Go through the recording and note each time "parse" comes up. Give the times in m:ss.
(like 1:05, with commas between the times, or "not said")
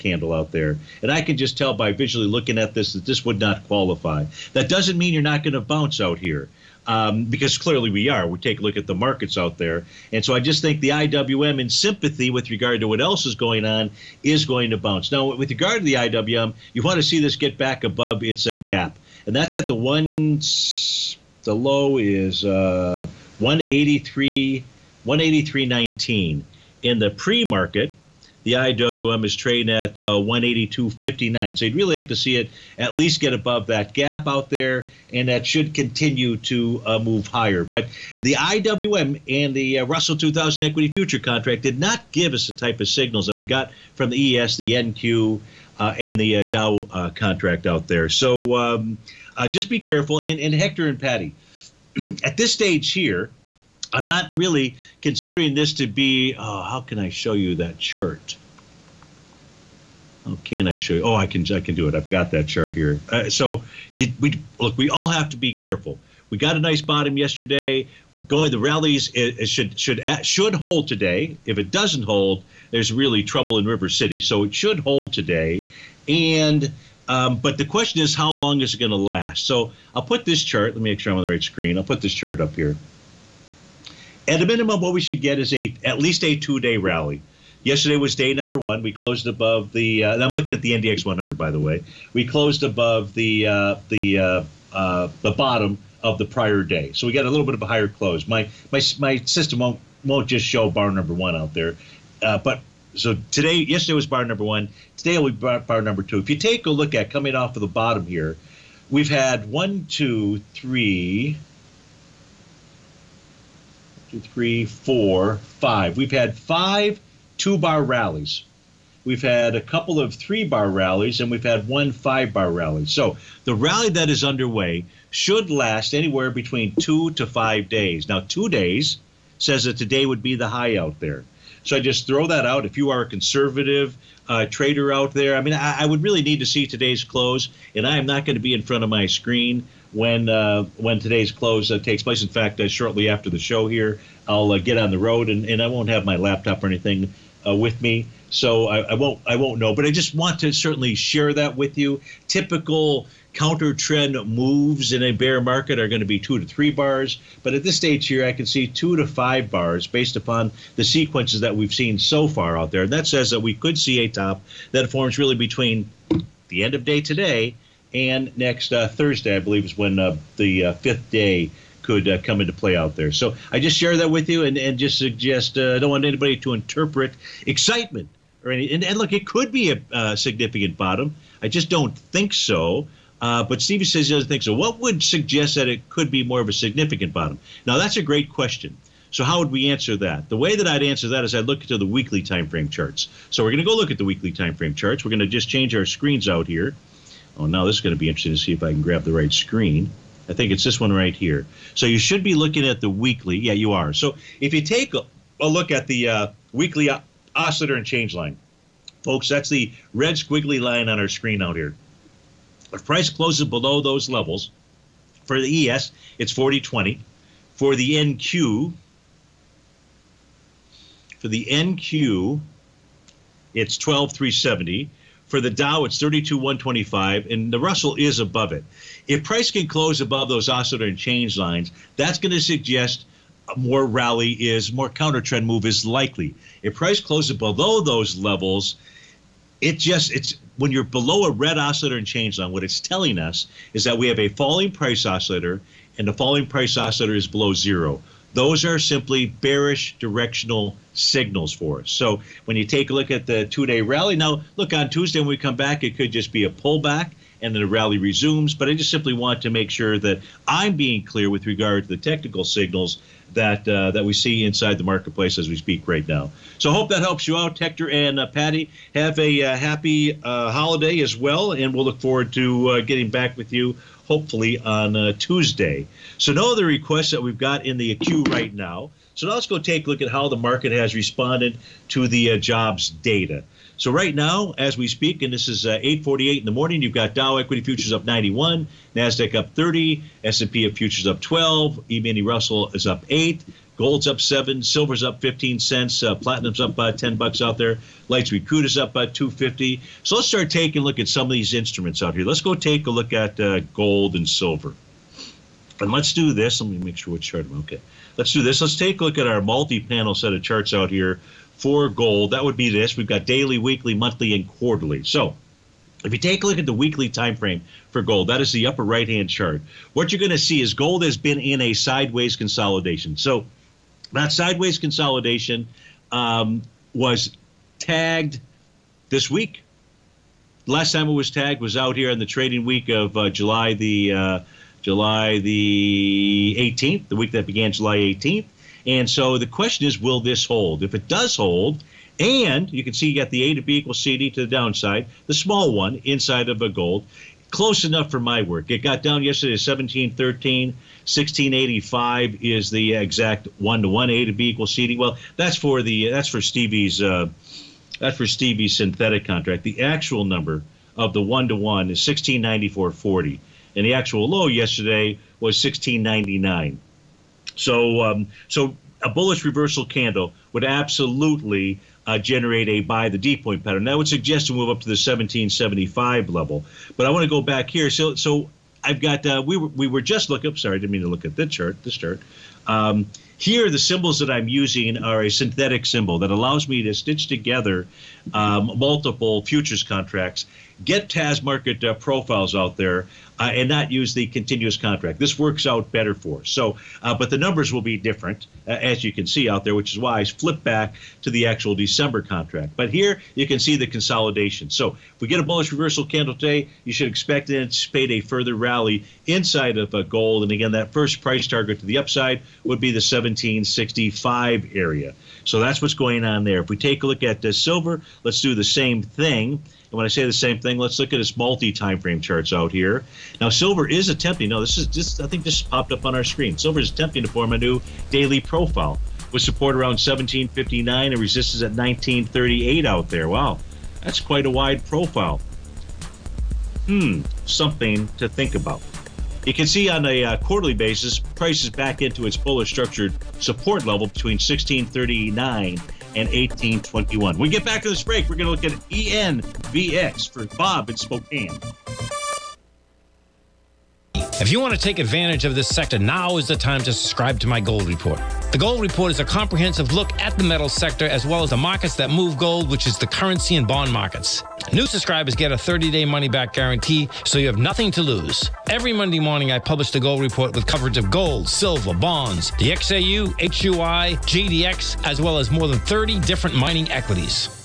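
not said.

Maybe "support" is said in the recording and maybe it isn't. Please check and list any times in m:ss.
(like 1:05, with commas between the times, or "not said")
7:09, 7:23.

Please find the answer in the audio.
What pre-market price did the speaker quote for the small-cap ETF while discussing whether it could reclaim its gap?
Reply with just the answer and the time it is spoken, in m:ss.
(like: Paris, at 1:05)
182.59, at 0:30.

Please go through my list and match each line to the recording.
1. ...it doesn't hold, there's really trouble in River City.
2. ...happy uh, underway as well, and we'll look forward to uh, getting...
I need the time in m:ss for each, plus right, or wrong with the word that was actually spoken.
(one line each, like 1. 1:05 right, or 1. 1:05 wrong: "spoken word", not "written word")
1. 1:11 right
2. 4:29 wrong: "holiday", not "underway".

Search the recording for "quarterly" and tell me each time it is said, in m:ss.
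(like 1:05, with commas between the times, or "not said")
5:14, 7:20.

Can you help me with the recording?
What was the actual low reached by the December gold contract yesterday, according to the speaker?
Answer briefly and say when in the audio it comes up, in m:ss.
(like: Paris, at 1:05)
1699, at 6:05.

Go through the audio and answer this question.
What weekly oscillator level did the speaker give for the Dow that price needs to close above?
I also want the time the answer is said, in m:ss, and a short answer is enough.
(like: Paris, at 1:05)
32,125, at 3:45.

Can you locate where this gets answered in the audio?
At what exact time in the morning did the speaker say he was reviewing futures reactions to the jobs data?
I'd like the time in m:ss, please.
4:45.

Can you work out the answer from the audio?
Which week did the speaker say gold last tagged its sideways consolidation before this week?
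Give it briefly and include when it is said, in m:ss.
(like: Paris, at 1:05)
week beginning July 18th, at 5:34.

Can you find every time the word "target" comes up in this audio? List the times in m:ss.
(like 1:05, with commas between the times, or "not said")
6:51.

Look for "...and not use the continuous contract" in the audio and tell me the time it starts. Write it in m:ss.
6:33.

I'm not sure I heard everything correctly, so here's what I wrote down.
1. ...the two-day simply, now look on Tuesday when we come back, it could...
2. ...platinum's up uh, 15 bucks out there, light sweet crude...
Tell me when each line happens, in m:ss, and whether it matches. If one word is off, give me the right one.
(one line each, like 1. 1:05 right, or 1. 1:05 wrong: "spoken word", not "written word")
1. 4:13 wrong: "rally", not "simply"
2. 4:56 wrong: "10", not "15".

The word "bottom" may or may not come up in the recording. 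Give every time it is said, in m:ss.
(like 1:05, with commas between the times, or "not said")
1:06, 1:35, 1:47, 3:00, 3:07.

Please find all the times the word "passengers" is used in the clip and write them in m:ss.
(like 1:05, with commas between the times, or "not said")
not said.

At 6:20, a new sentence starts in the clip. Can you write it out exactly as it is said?
Up, sorry, I didn't mean to look at this chart.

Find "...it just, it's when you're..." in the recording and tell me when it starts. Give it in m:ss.
3:59.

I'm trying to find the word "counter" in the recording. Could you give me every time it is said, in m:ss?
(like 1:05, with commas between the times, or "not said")
2:33, 3:54.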